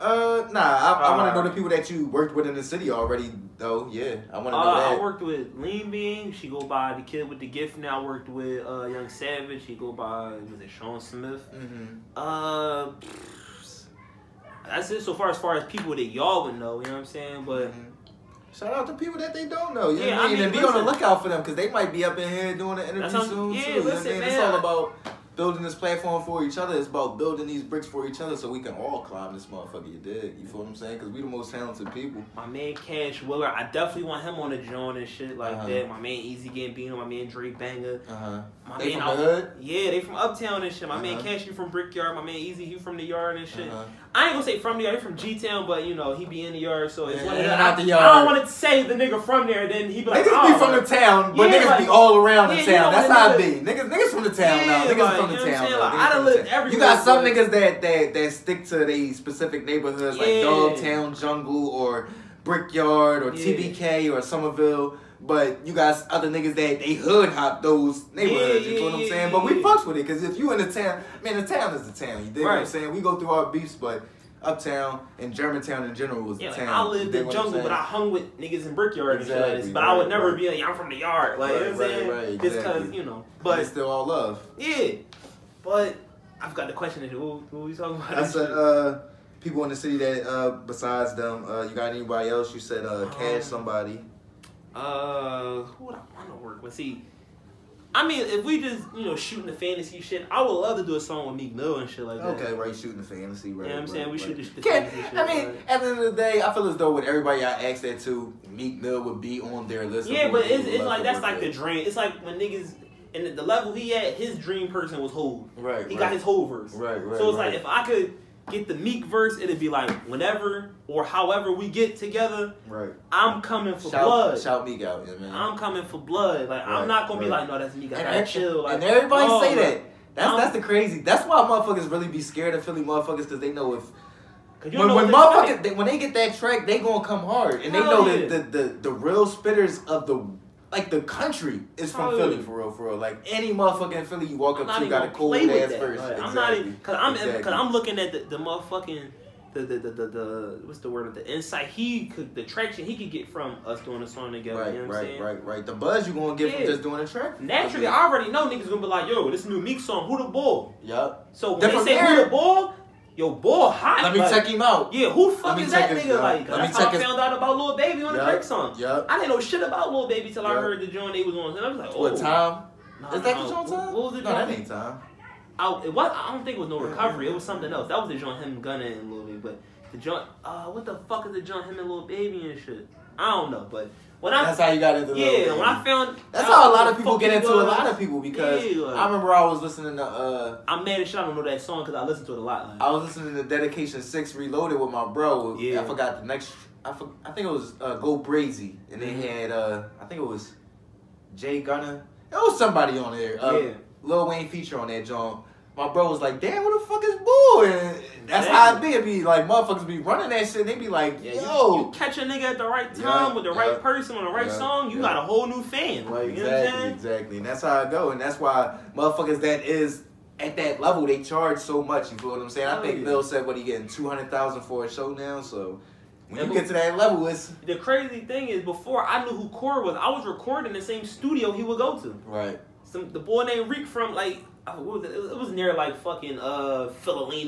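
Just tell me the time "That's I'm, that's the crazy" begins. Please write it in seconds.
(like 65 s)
130 s.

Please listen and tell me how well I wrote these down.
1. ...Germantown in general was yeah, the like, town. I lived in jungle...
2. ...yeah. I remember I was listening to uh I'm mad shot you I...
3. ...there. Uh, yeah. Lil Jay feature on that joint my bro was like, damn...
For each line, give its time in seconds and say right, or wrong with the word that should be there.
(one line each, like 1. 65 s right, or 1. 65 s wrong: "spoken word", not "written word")
1. 75 s right
2. 188 s right
3. 203 s wrong: "Wayne", not "Jay".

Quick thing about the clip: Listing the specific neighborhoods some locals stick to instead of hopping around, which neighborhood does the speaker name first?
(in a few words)
Dogtown.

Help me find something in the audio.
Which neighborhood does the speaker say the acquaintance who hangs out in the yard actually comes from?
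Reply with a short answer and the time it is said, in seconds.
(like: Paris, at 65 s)
G Town, at 45 s.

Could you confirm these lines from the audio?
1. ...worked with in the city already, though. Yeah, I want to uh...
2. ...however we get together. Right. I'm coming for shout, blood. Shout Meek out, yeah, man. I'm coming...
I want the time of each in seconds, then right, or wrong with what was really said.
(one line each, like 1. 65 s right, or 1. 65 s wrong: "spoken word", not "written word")
1. 2 s right
2. 121 s right.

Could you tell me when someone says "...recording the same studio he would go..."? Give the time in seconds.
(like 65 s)
230 s.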